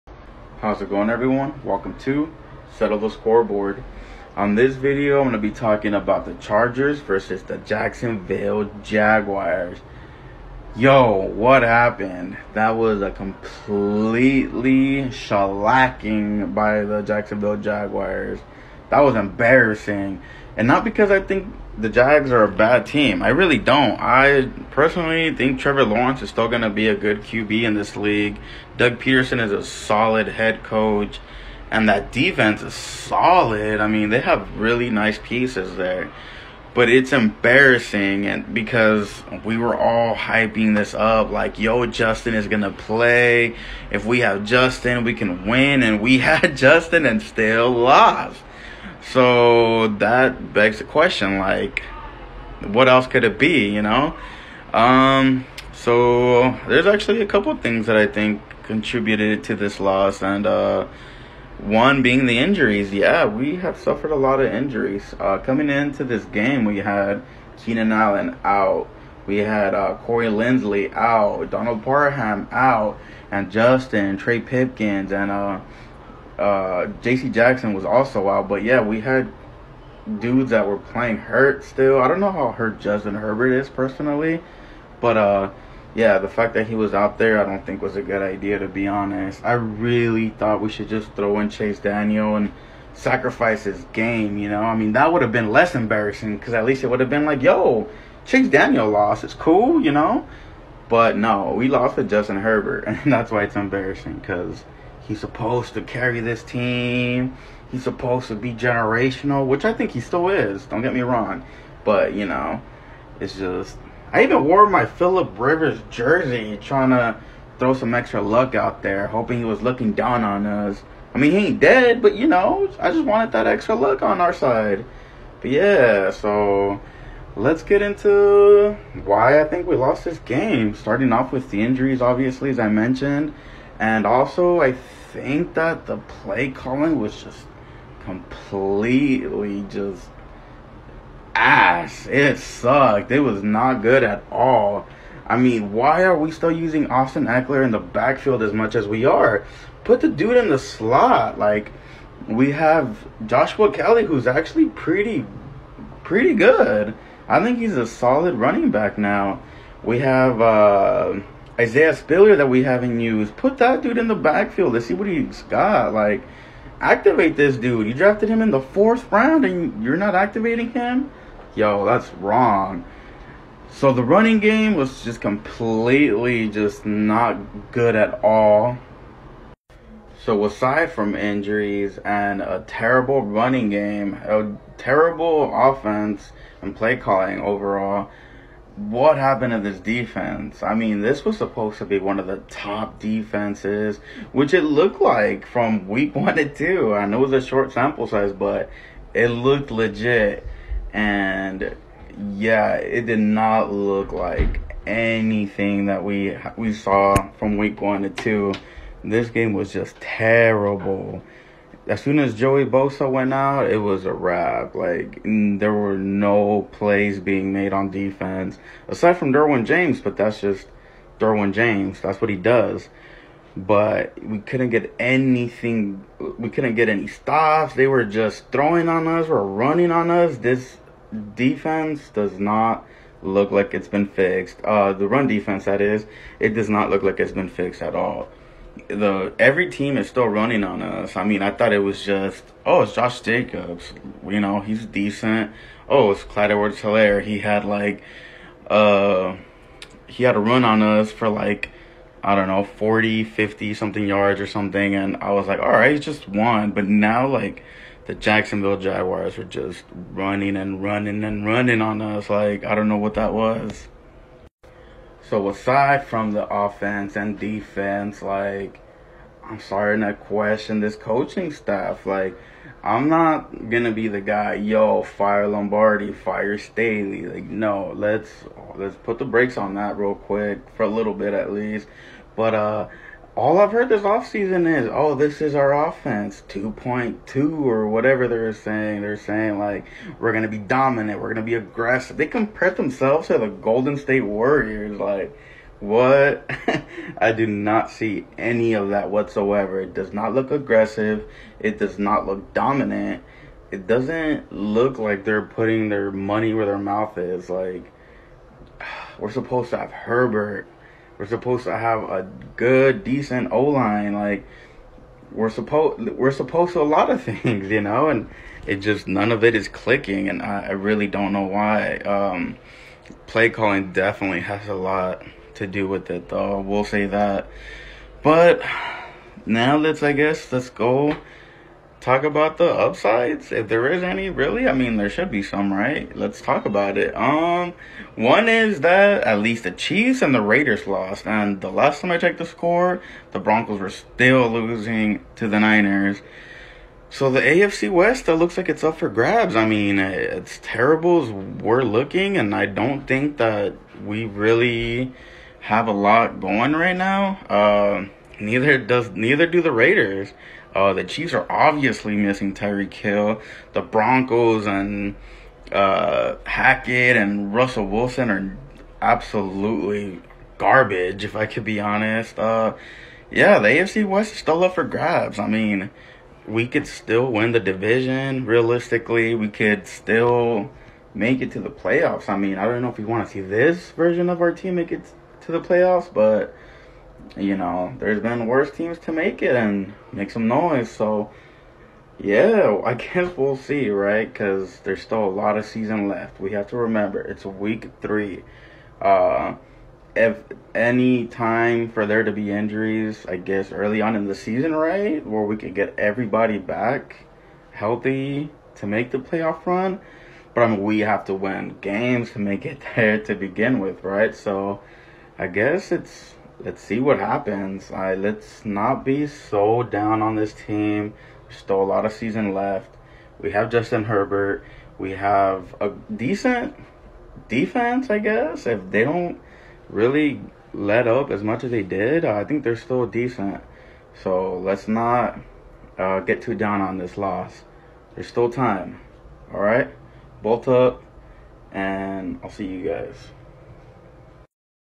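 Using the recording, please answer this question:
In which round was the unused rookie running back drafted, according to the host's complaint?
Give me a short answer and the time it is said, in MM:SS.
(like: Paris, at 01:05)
Fourth round, at 02:48.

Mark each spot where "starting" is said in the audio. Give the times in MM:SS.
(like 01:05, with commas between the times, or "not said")
02:10, 04:29.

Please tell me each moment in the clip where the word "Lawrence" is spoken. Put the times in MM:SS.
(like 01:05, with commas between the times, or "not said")
00:25.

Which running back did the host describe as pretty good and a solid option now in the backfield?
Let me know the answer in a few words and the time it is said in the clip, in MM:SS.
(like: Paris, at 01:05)
Joshua Kelley, at 02:33.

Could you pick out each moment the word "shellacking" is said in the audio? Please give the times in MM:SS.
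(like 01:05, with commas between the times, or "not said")
00:15.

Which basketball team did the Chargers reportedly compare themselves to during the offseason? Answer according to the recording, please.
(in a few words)
Golden State Warriors.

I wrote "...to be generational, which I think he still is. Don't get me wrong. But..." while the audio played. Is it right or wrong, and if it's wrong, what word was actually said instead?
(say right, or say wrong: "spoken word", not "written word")
right.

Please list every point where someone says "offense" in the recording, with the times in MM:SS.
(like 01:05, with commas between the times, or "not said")
03:05, 04:26, 04:45.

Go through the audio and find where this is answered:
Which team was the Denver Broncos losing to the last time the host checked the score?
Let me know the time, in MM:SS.
05:45.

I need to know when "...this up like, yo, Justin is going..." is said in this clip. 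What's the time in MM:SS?
00:40.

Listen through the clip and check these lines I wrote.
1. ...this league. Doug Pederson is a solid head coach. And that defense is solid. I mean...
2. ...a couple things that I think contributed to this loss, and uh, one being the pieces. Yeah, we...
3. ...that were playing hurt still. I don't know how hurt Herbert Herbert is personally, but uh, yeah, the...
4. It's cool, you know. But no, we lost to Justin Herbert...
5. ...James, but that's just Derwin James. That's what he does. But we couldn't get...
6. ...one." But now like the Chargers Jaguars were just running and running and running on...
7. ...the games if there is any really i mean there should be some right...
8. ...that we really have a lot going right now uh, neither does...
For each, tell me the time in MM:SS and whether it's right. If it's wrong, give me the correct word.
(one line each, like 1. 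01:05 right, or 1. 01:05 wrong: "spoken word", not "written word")
1. 00:27 right
2. 00:57 wrong: "injuries", not "pieces"
3. 01:20 wrong: "Justin", not "Herbert"
4. 01:39 right
5. 03:39 right
6. 04:16 wrong: "Jacksonville", not "Chargers"
7. 05:32 wrong: "upsides", not "games"
8. 05:53 right.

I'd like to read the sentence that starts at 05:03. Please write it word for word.
It doesn't look like they're putting their money where their mouth is.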